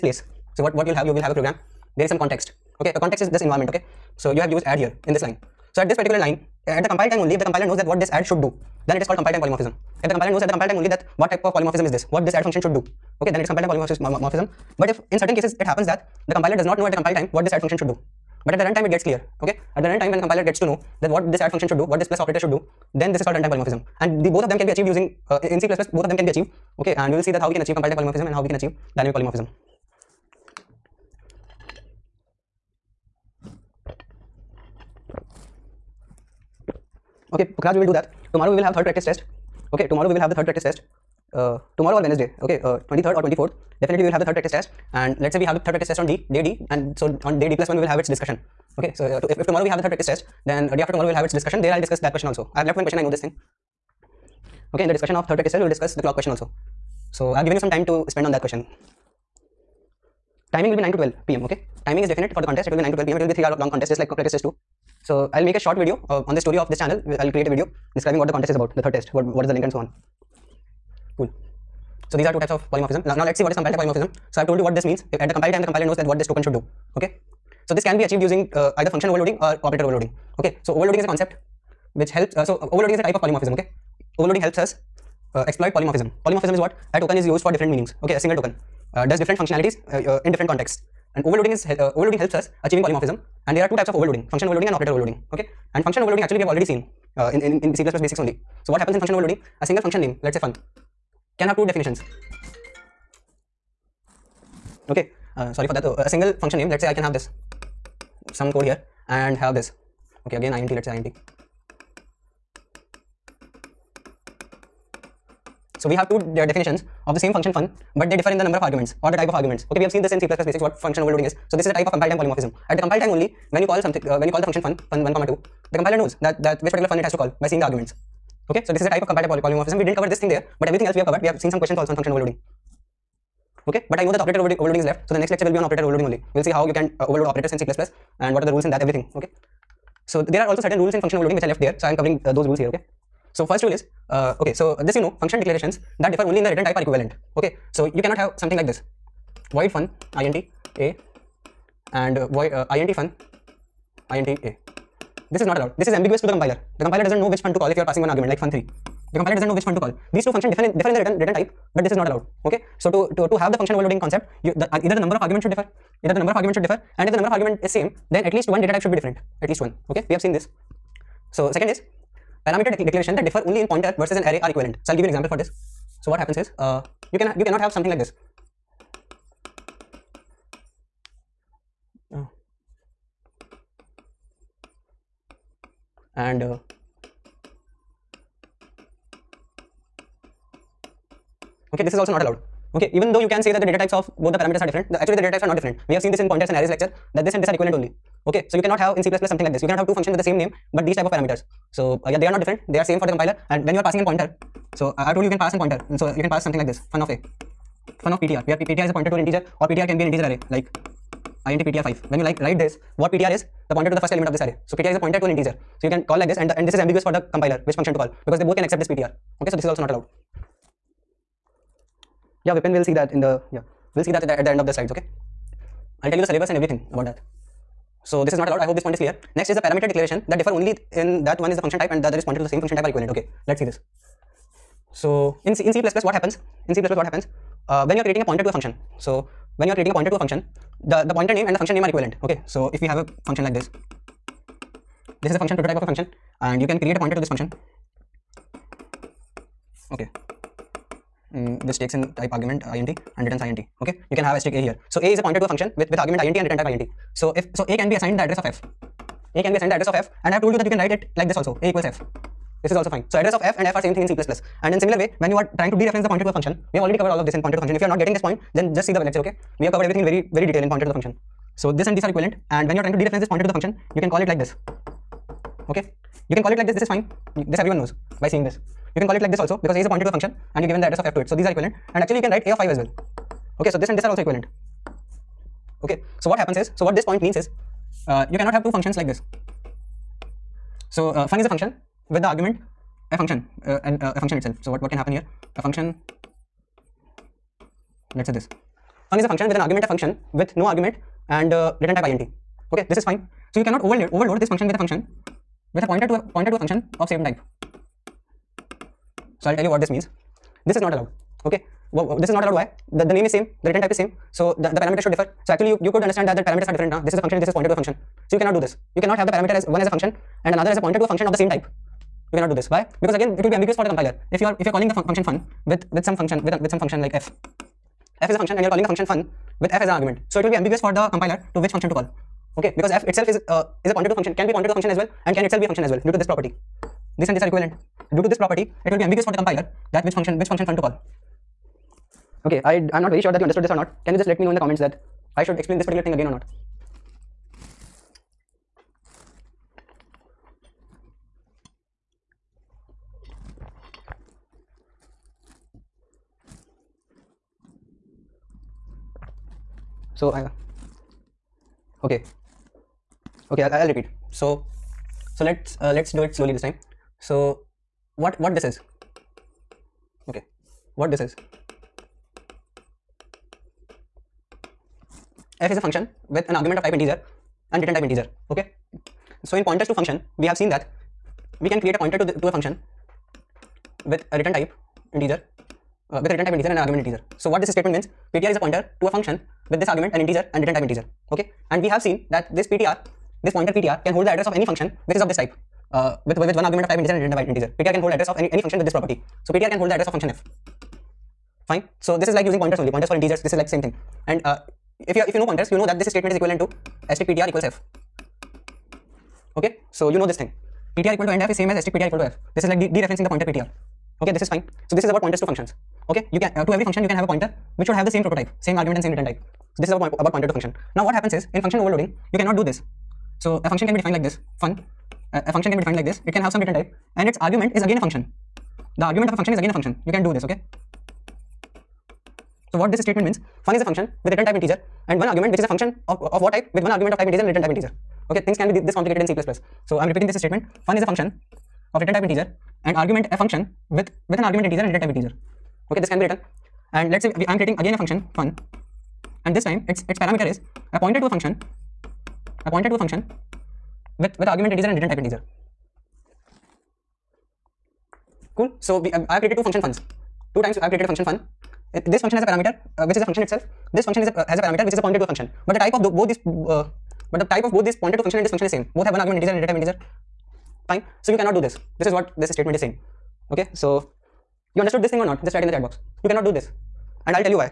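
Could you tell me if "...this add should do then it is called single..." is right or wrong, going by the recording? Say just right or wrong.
wrong.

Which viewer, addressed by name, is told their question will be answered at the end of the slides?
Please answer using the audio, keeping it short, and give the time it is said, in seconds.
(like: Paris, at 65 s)
Vipin, at 222 s.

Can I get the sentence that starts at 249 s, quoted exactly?
Okay, mm, which takes in type argument uh, int and returns int.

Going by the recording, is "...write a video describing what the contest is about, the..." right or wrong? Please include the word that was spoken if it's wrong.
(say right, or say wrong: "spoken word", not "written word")
wrong: "create", not "write".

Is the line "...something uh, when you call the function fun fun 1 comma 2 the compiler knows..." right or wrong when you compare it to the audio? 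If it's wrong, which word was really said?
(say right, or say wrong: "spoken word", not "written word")
right.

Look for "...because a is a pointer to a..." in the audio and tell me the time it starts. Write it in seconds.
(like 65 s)
279 s.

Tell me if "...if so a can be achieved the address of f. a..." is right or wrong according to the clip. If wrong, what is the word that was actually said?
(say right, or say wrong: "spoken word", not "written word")
wrong: "assigned", not "achieved".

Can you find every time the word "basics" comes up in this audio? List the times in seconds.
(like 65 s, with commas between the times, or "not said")
97 s, 120 s.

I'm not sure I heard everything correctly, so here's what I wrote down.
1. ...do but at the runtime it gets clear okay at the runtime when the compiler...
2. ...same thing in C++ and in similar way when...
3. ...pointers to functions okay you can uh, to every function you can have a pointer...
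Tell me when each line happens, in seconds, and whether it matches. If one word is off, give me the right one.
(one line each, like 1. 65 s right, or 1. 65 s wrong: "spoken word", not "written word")
1. 17 s right
2. 263 s right
3. 415 s right.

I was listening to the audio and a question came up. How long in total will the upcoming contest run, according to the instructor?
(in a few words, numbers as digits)
3 hours.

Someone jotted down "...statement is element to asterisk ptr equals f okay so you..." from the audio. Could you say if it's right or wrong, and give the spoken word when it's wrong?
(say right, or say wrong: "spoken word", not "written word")
wrong: "equivalent", not "element".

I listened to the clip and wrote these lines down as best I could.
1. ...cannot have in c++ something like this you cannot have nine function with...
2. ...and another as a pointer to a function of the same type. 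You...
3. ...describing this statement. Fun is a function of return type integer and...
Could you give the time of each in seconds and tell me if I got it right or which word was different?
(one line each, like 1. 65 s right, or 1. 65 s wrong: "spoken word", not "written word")
1. 198 s wrong: "two", not "nine"
2. 320 s right
3. 440 s wrong: "repeating", not "describing".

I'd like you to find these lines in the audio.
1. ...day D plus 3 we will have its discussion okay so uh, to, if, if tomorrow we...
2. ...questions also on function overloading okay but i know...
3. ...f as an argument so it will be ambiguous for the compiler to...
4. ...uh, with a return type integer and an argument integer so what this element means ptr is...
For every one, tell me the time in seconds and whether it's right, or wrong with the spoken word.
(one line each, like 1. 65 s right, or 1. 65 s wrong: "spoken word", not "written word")
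1. 47 s wrong: "1", not "3"
2. 131 s right
3. 329 s right
4. 386 s wrong: "statement", not "element".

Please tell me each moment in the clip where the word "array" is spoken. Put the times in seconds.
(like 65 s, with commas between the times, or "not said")
174 s, 196 s, 210 s, 214 s.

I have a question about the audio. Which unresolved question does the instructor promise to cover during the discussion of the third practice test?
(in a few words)
The clock question.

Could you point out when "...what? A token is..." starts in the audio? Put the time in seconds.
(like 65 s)
86 s.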